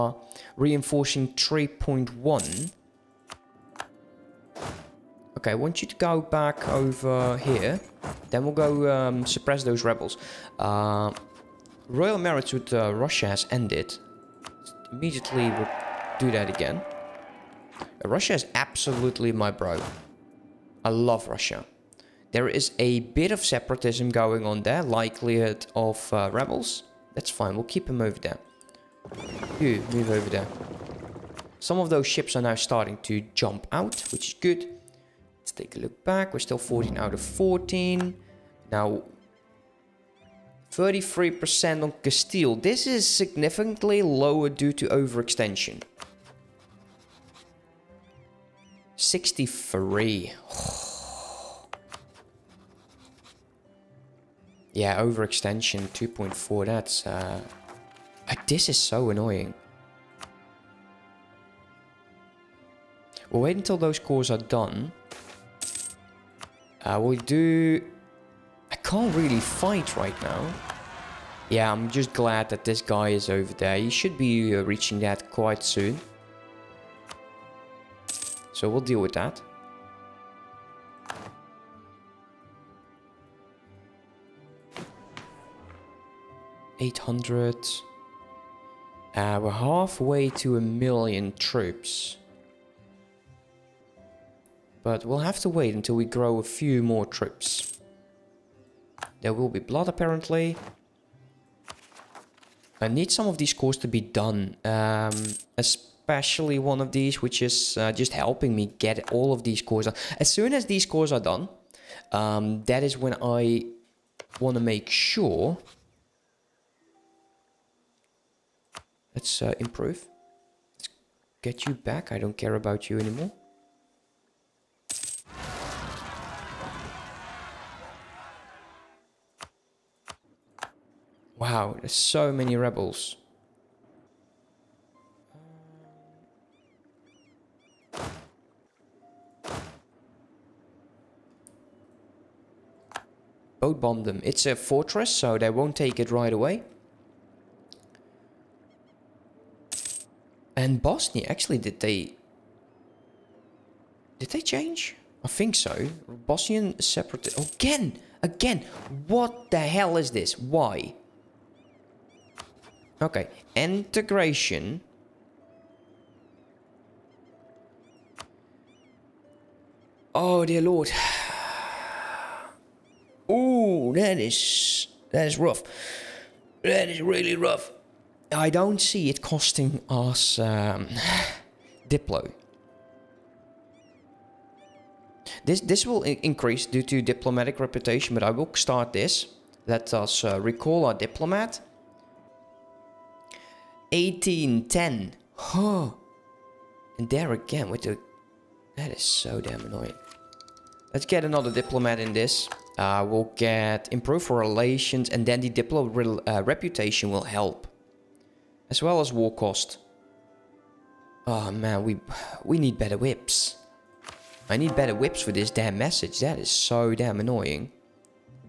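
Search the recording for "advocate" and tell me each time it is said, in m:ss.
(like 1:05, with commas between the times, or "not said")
not said.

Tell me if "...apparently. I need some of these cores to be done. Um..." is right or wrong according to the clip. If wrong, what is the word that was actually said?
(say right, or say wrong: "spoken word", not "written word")
right.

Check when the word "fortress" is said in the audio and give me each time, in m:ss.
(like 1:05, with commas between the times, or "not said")
2:24.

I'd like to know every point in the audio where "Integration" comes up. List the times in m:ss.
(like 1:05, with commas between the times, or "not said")
2:43.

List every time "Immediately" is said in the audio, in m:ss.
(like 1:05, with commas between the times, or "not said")
0:14.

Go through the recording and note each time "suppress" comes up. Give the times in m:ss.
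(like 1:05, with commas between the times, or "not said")
0:09.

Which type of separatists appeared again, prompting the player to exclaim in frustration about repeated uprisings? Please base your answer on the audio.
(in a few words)
Bosnian.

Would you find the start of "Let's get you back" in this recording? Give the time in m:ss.
2:00.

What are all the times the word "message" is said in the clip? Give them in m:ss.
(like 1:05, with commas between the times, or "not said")
3:35.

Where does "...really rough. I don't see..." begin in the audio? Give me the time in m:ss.
2:56.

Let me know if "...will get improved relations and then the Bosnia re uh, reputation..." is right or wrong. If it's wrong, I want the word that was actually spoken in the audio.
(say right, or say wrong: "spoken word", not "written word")
wrong: "Diplo", not "Bosnia".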